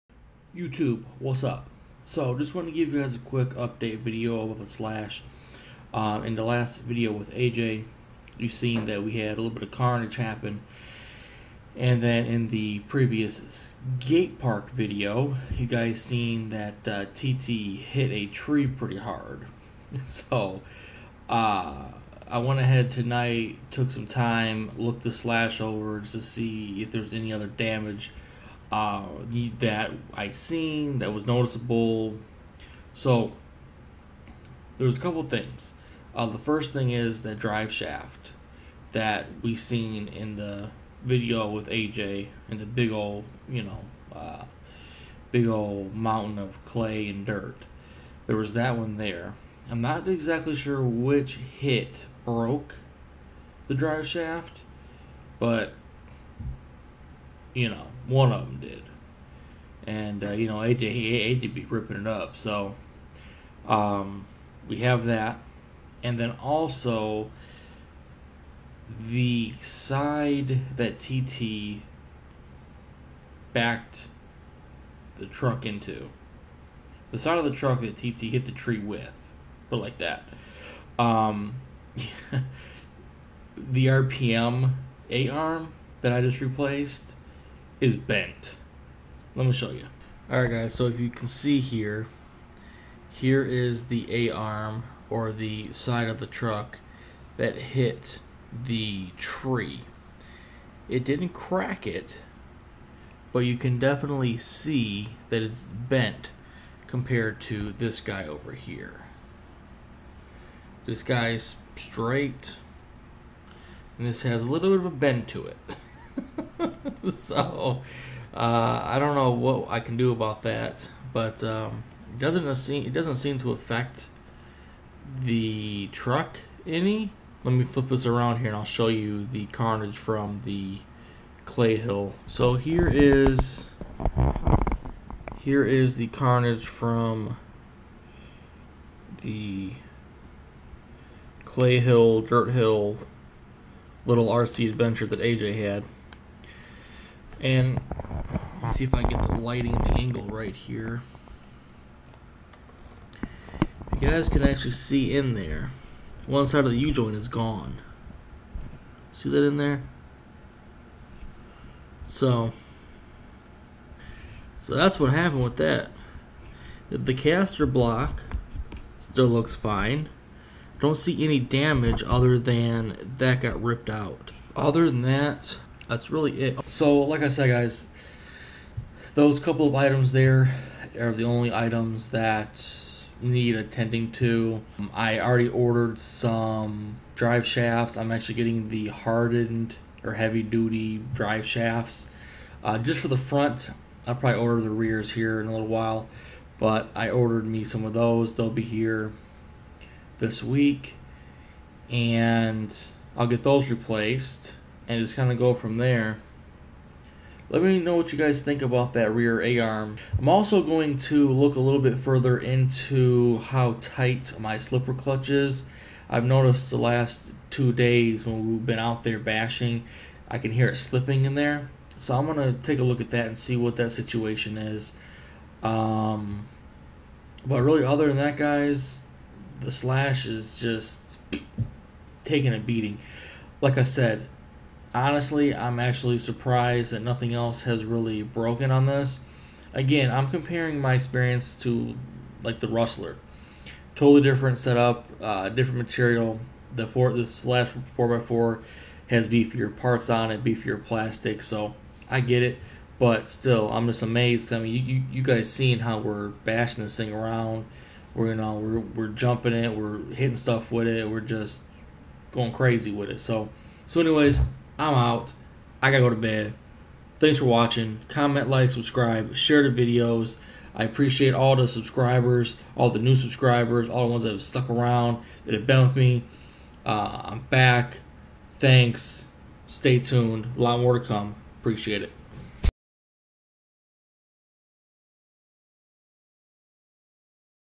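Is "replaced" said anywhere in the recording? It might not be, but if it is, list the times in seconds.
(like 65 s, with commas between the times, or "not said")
86 s, 203 s.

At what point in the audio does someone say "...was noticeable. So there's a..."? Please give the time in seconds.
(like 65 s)
31 s.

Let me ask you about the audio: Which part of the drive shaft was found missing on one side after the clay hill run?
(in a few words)
U-joint.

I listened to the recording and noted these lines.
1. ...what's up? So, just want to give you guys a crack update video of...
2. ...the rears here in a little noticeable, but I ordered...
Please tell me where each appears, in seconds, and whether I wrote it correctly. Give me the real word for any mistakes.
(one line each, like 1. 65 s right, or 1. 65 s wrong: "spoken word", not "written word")
1. 1 s wrong: "quick", not "crack"
2. 194 s wrong: "while", not "noticeable".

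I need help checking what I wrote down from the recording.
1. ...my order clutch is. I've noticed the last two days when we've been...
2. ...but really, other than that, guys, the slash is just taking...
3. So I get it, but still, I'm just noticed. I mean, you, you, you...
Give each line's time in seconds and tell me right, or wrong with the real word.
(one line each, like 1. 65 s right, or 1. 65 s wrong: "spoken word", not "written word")
1. 214 s wrong: "slipper", not "order"
2. 227 s right
3. 251 s wrong: "amazed", not "noticed".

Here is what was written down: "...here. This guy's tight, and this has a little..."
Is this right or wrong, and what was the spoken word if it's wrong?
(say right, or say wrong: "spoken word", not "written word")
wrong: "straight", not "tight".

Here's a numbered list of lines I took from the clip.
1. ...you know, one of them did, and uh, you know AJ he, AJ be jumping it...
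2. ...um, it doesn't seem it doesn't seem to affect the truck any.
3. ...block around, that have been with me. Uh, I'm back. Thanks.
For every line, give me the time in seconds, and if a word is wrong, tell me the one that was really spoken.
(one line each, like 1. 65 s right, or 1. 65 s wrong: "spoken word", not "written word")
1. 57 s wrong: "ripping", not "jumping"
2. 121 s right
3. 274 s wrong: "stuck", not "block".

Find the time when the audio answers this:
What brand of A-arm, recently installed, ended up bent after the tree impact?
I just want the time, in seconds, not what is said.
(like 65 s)
83 s.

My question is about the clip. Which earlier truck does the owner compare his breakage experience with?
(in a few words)
Rustler.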